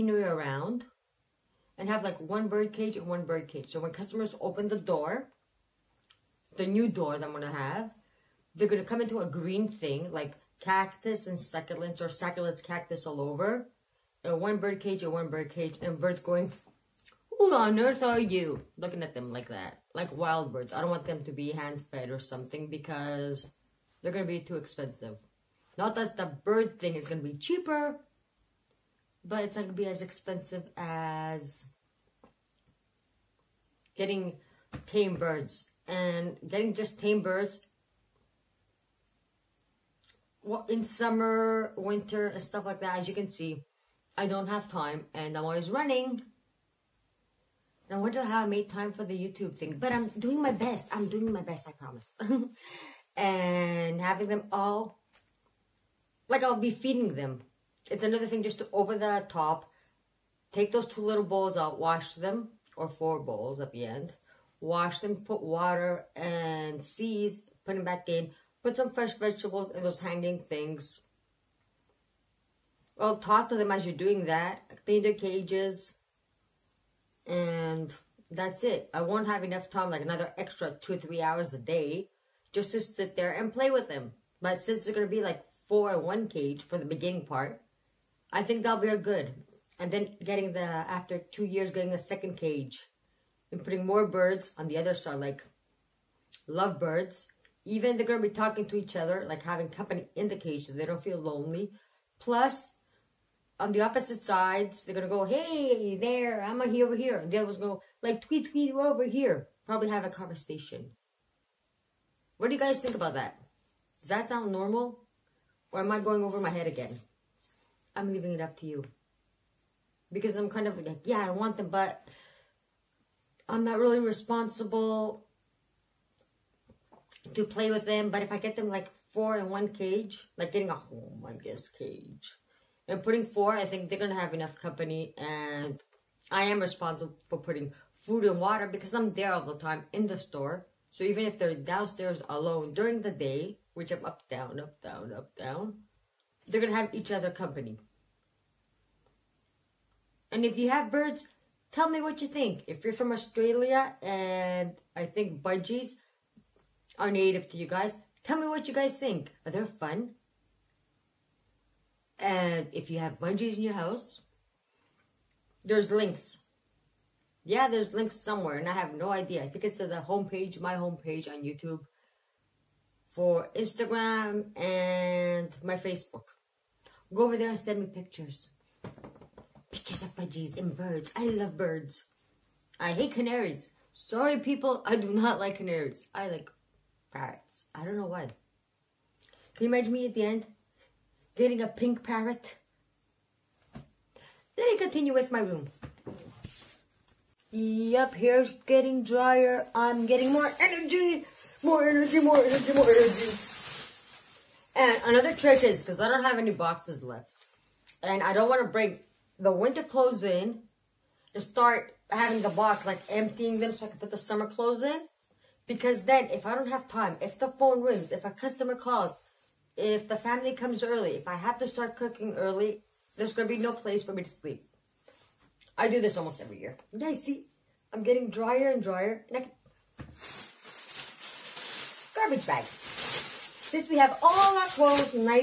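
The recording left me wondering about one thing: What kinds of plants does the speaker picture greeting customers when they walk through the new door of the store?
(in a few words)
cactus and succulents.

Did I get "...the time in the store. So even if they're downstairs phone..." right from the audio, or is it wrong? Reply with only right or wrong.
wrong.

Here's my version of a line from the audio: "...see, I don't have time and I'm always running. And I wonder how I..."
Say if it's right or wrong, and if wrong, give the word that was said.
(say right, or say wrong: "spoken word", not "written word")
right.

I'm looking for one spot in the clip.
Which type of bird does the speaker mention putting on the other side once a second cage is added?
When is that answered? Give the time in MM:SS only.
01:36.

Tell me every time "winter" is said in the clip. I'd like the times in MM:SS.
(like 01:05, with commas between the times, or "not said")
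00:41, 03:29.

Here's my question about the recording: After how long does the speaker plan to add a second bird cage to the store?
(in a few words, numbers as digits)
2 years.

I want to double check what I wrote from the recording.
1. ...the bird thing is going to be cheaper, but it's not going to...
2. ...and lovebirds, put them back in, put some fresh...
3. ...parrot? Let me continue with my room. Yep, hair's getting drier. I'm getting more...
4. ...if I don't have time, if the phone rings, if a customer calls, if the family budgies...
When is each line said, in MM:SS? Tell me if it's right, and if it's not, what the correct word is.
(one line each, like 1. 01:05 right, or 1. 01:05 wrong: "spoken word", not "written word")
1. 00:26 right
2. 01:06 wrong: "seeds", not "lovebirds"
3. 03:12 right
4. 03:36 wrong: "comes", not "budgies".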